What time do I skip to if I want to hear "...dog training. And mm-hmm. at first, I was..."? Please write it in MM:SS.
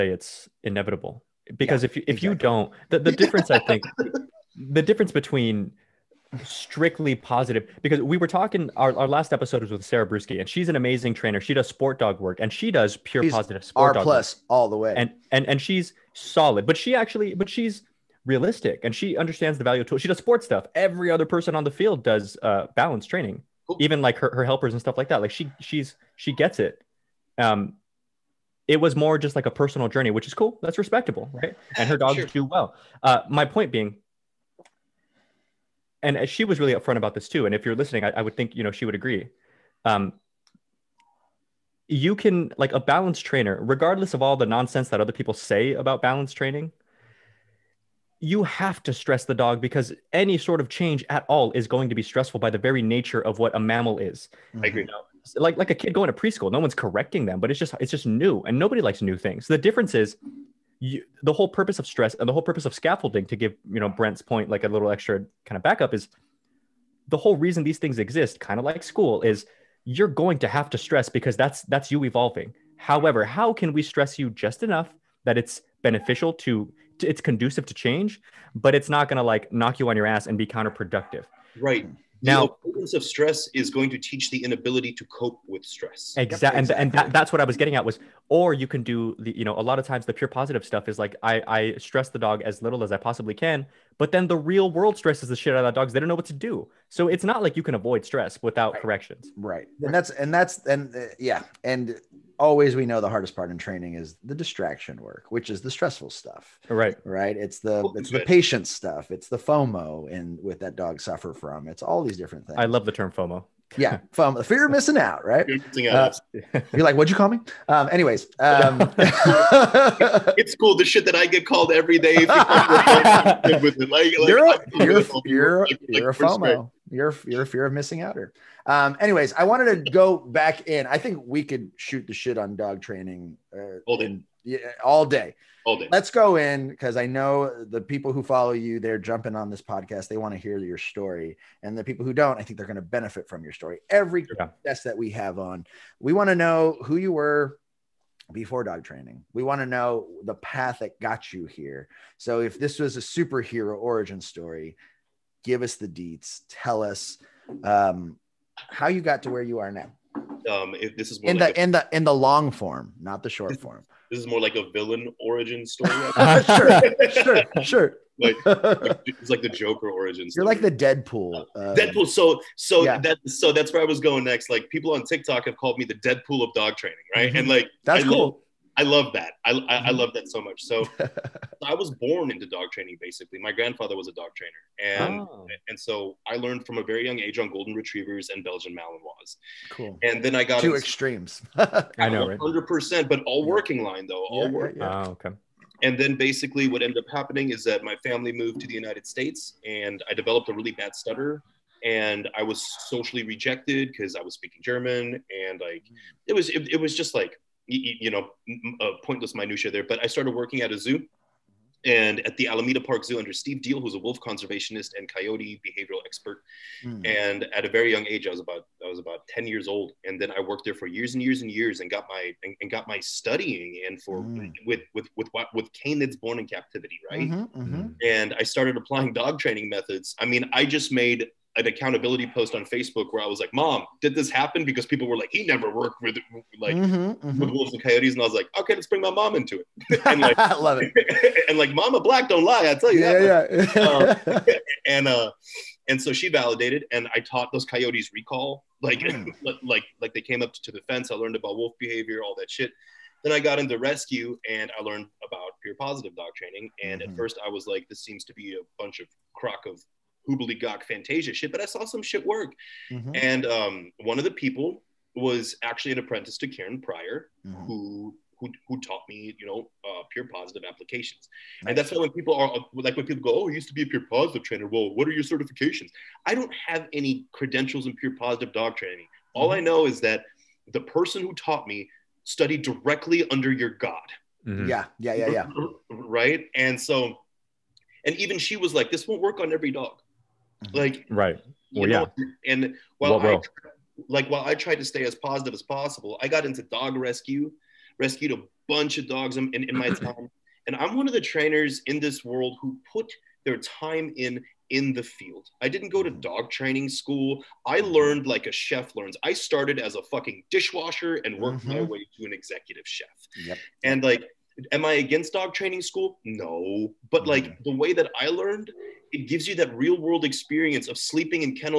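04:16.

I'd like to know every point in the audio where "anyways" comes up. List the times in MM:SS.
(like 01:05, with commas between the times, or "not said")
01:57, 02:08.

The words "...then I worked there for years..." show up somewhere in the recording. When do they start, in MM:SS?
03:40.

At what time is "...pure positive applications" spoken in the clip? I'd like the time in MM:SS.
04:30.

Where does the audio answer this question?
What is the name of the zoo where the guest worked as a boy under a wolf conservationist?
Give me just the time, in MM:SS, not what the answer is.
03:32.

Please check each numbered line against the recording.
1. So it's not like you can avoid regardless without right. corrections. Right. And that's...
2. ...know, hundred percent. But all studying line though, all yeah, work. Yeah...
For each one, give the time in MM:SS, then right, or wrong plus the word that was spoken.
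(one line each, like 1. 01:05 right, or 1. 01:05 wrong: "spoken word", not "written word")
1. 01:36 wrong: "stress", not "regardless"
2. 03:12 wrong: "working", not "studying".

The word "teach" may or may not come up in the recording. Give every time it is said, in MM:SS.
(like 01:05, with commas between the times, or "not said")
01:23.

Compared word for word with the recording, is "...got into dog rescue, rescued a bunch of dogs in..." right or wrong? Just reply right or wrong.
right.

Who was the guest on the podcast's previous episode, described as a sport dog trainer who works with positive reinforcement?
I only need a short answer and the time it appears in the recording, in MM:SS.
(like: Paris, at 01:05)
Sarah Brusky, at 00:09.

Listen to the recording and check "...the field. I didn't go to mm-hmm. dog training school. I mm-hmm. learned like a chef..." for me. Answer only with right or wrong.
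right.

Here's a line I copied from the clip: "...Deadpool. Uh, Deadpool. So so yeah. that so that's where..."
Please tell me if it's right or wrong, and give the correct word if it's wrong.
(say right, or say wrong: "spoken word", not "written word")
right.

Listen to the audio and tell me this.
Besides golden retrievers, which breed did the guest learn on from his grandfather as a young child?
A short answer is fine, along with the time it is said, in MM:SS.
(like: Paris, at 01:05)
Belgian Malinois, at 03:08.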